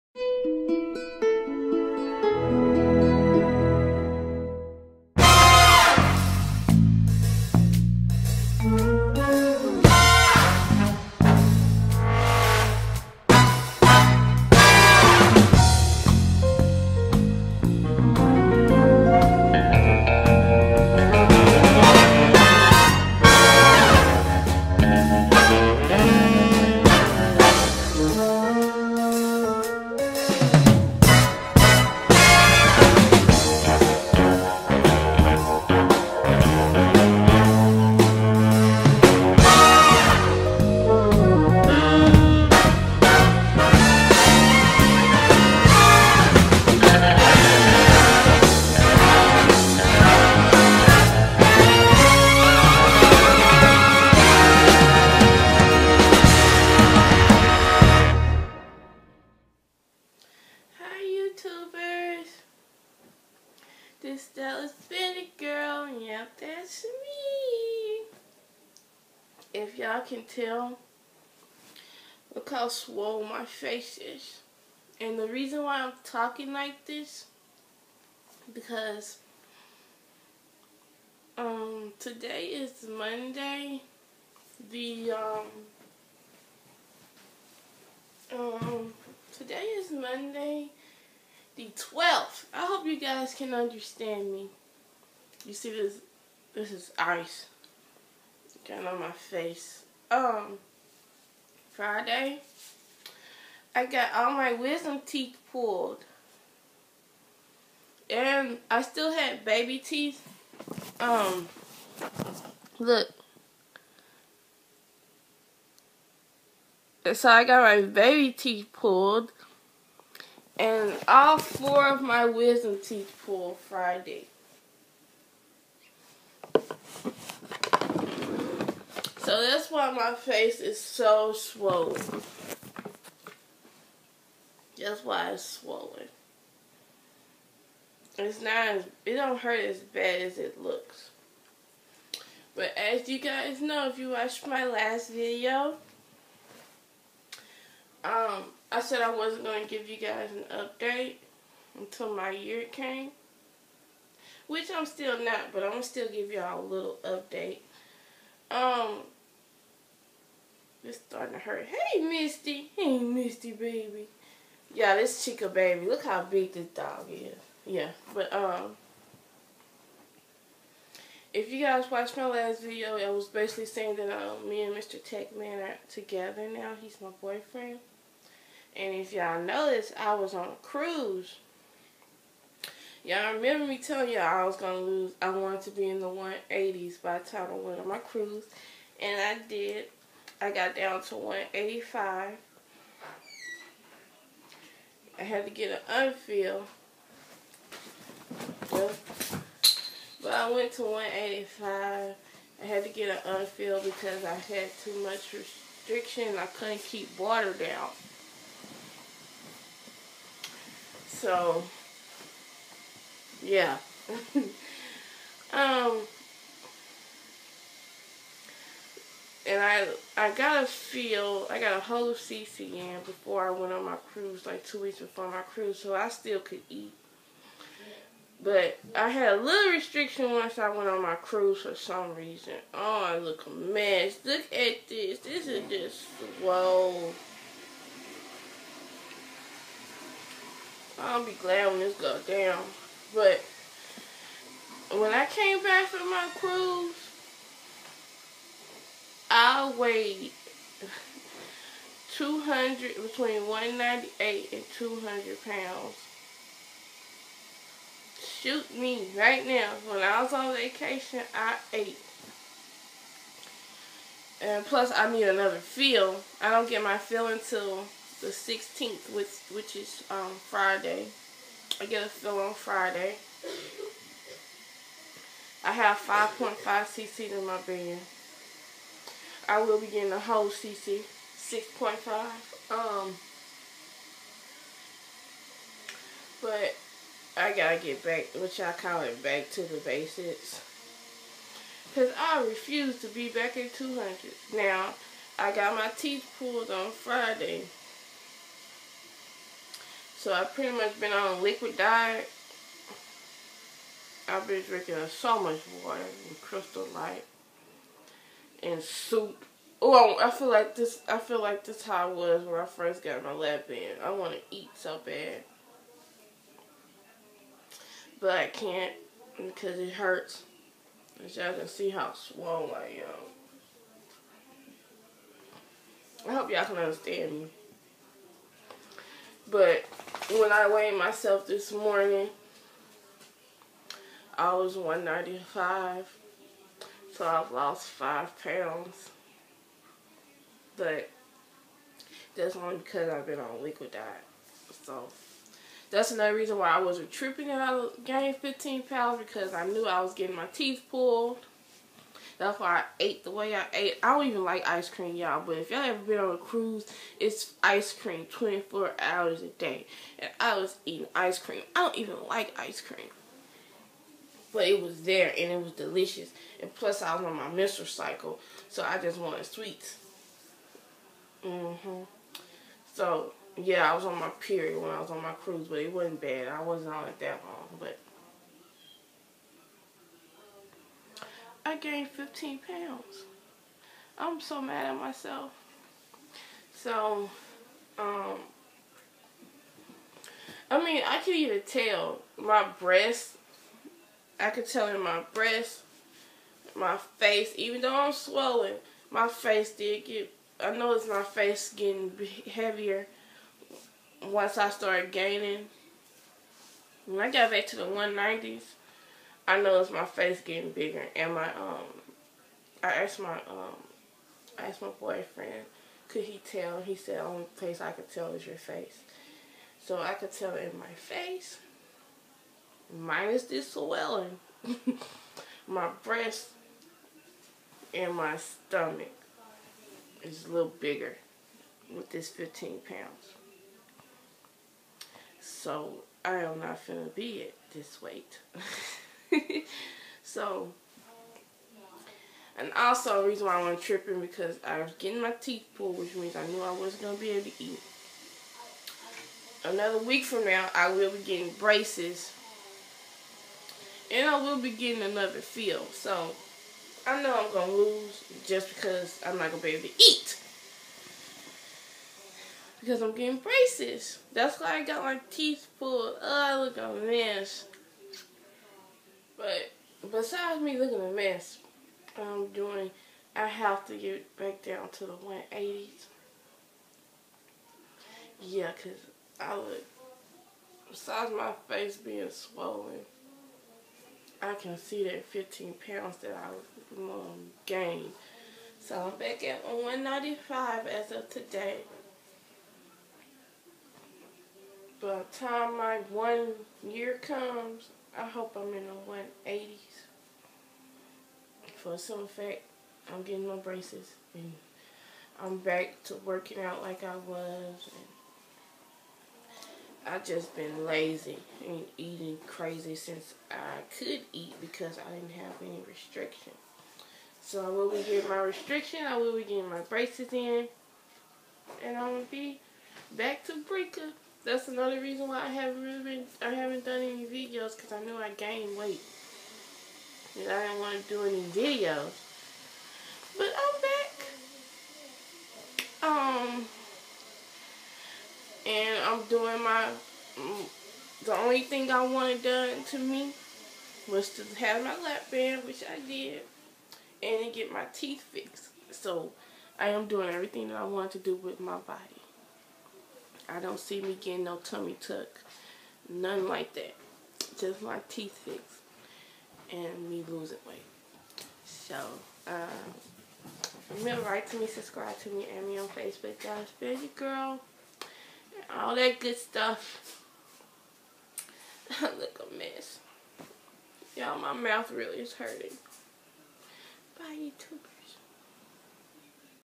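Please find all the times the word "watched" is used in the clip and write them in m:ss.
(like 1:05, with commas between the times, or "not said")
2:24, 2:51.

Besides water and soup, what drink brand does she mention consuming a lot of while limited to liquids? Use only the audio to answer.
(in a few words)
Crystal Light.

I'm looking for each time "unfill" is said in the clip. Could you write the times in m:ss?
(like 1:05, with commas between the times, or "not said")
3:16, 3:23.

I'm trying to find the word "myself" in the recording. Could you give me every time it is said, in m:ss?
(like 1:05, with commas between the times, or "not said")
5:30, 6:24.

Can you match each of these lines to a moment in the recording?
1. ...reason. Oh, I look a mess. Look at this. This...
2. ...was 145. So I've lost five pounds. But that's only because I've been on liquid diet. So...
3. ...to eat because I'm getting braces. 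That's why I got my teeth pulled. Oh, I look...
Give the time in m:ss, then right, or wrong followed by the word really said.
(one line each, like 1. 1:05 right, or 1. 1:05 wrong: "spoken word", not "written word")
1. 3:52 right
2. 5:34 wrong: "195", not "145"
3. 7:39 right.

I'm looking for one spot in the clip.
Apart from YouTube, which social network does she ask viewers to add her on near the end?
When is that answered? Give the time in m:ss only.
9:25.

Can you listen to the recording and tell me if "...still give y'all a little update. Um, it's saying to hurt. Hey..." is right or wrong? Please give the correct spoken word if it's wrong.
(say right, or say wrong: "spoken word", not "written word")
wrong: "starting", not "saying".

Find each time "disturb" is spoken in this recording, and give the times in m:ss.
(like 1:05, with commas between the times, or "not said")
not said.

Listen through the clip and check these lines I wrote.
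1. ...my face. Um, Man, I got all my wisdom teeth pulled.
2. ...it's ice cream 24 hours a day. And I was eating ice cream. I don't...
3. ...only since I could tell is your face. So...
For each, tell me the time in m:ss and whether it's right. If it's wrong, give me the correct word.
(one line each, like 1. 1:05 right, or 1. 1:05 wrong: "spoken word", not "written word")
1. 1:38 wrong: "Friday", not "Man"
2. 5:57 right
3. 6:57 wrong: "place", not "since".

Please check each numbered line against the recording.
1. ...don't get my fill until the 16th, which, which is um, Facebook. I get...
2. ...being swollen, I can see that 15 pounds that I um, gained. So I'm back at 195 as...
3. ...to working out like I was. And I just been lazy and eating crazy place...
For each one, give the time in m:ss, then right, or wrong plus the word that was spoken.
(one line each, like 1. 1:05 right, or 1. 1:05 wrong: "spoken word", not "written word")
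1. 4:26 wrong: "Friday", not "Facebook"
2. 8:01 right
3. 8:26 wrong: "since", not "place".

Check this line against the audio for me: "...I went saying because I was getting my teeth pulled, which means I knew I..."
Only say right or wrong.
wrong.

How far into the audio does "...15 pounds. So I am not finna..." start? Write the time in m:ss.
7:12.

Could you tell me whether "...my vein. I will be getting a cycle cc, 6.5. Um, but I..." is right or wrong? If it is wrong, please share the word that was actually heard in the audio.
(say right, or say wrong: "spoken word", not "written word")
wrong: "whole", not "cycle".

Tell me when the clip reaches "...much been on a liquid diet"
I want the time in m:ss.
5:00.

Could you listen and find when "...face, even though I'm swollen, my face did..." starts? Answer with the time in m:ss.
6:37.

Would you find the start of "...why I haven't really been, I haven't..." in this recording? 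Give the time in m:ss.
8:45.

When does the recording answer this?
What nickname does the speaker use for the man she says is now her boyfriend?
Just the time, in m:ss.
2:54.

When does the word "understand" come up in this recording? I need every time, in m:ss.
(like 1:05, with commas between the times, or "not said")
1:33, 5:26.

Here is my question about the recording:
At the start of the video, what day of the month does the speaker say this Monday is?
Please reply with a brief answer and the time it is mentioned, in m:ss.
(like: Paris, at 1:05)
12th, at 1:31.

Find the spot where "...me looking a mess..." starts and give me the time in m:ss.
7:50.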